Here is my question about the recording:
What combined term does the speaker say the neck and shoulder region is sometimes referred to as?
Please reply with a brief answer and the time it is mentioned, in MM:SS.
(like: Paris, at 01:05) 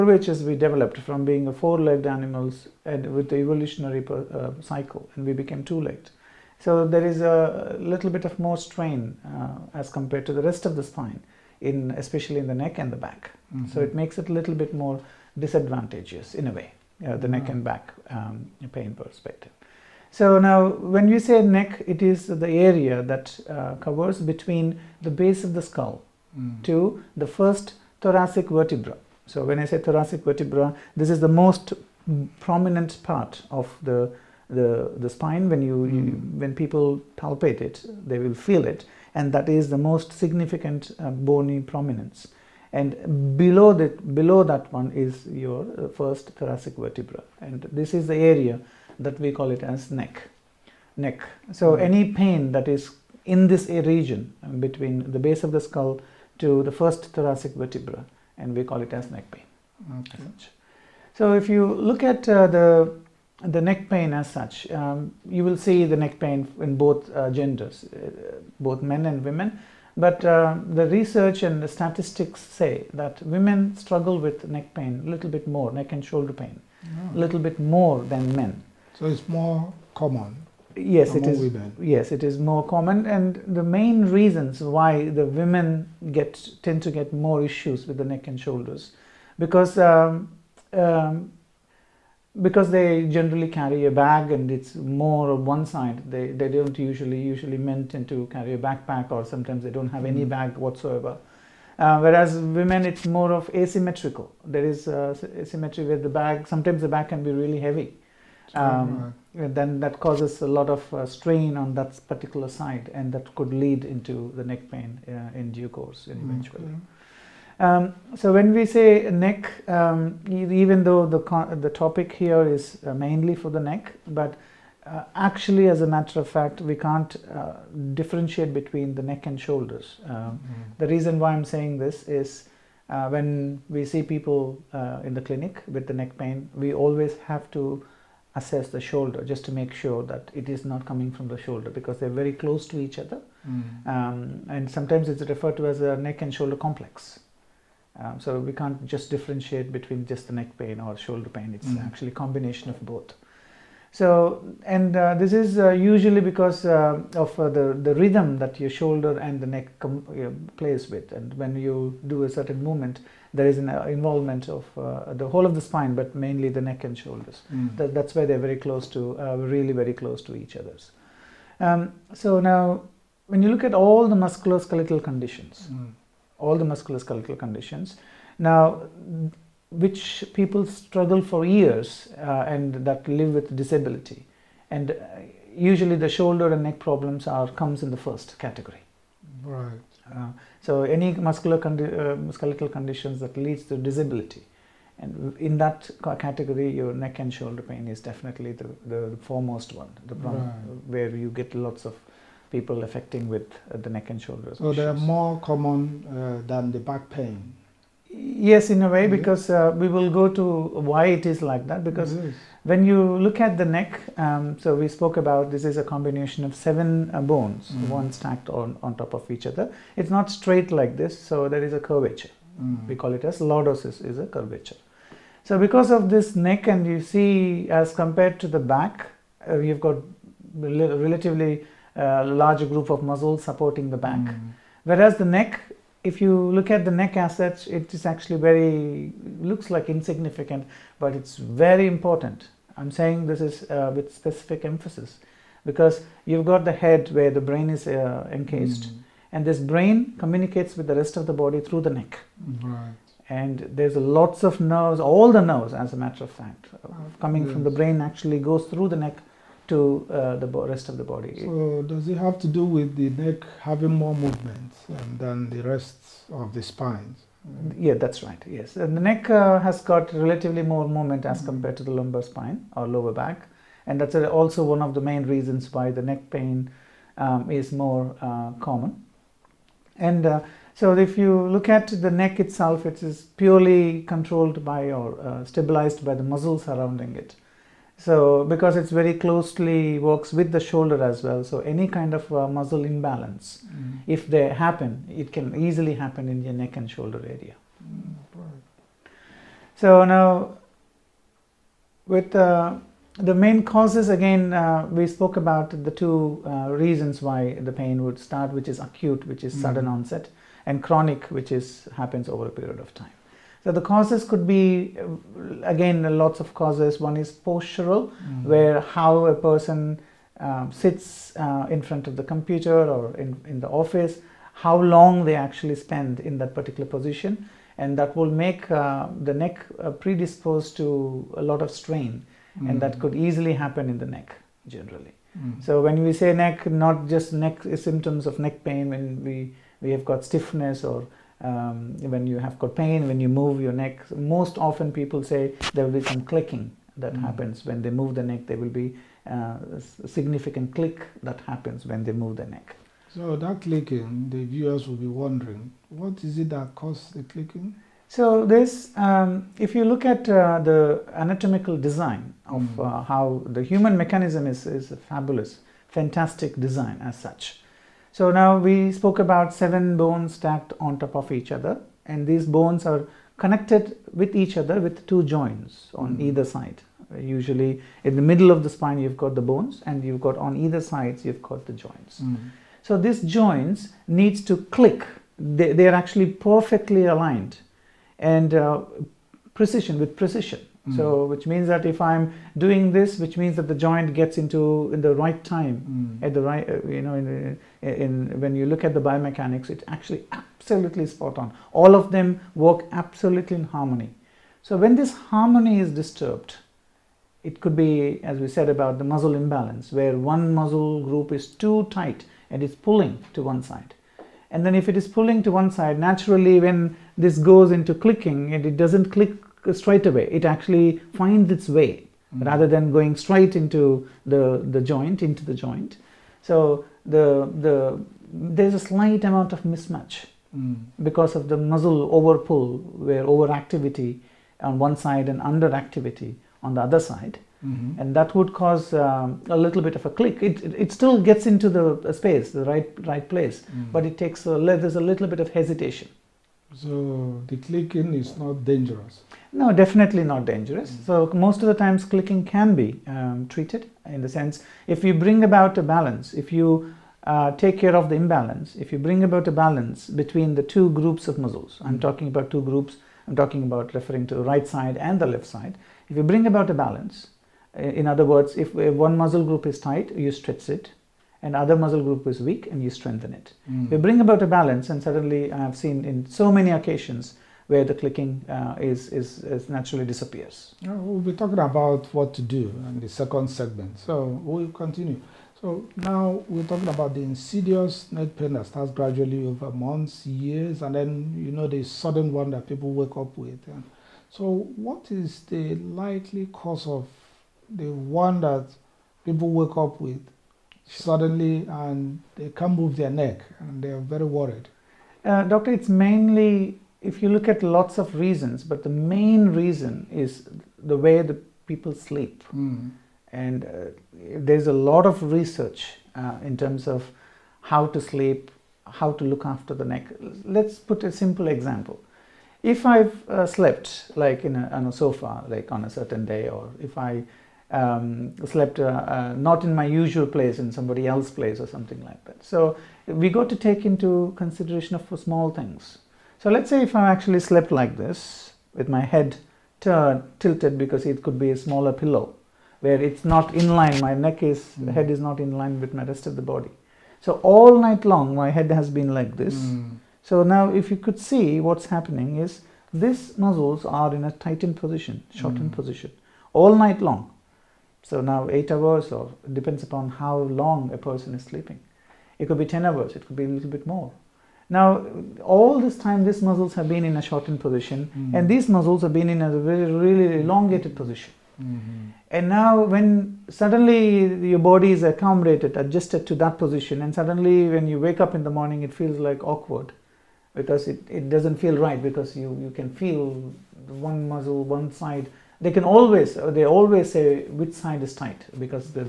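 neck and shoulder complex, at 02:25.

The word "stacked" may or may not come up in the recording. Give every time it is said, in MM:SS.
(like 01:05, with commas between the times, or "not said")
03:38, 06:10.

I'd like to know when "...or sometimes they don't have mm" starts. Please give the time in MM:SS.
01:39.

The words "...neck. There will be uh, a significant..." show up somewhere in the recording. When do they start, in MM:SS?
05:48.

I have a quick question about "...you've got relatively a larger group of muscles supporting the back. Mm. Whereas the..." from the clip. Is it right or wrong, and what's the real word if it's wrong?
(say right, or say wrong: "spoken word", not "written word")
right.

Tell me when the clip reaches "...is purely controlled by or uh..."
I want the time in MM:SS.
04:43.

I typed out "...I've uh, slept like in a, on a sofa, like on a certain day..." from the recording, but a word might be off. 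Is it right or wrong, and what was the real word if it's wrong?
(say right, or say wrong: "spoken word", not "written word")
right.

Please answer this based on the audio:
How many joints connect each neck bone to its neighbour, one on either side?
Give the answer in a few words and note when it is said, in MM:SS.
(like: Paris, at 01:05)
2, at 06:15.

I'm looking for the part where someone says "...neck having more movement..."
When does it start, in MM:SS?
04:23.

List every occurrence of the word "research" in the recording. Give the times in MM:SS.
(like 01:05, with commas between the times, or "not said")
01:10, 08:35.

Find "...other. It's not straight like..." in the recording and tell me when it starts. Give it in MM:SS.
03:39.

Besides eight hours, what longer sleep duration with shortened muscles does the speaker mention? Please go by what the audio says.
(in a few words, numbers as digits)
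10.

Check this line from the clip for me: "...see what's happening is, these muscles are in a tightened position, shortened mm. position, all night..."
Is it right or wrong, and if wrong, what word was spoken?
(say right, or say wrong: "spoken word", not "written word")
right.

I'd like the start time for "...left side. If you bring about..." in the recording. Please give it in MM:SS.
07:45.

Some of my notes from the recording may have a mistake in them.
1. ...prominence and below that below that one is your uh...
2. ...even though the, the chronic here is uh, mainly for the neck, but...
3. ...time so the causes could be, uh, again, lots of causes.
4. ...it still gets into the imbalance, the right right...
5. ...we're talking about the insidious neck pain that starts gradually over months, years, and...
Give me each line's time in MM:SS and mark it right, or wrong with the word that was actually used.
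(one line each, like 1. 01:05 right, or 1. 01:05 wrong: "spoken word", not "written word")
1. 00:41 right
2. 02:00 wrong: "topic", not "chronic"
3. 05:12 right
4. 07:20 wrong: "space", not "imbalance"
5. 08:06 right.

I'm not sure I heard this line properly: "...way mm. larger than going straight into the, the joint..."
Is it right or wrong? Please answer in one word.
wrong.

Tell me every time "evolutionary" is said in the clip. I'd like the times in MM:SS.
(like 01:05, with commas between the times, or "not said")
00:03.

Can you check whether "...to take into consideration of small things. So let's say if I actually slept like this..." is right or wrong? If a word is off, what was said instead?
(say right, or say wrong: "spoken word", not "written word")
right.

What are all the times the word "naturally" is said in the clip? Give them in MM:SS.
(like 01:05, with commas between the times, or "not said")
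06:55, 07:59.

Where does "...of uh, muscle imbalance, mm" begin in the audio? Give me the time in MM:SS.
04:52.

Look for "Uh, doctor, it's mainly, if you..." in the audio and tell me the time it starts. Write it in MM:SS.
08:25.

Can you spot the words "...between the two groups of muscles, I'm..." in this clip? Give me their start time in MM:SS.
07:40.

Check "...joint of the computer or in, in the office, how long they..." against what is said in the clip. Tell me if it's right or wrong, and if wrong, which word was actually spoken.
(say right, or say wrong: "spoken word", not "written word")
wrong: "front", not "joint".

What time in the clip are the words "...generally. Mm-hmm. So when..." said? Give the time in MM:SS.
05:34.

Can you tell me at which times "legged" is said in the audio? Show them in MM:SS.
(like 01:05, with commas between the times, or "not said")
00:01, 00:05.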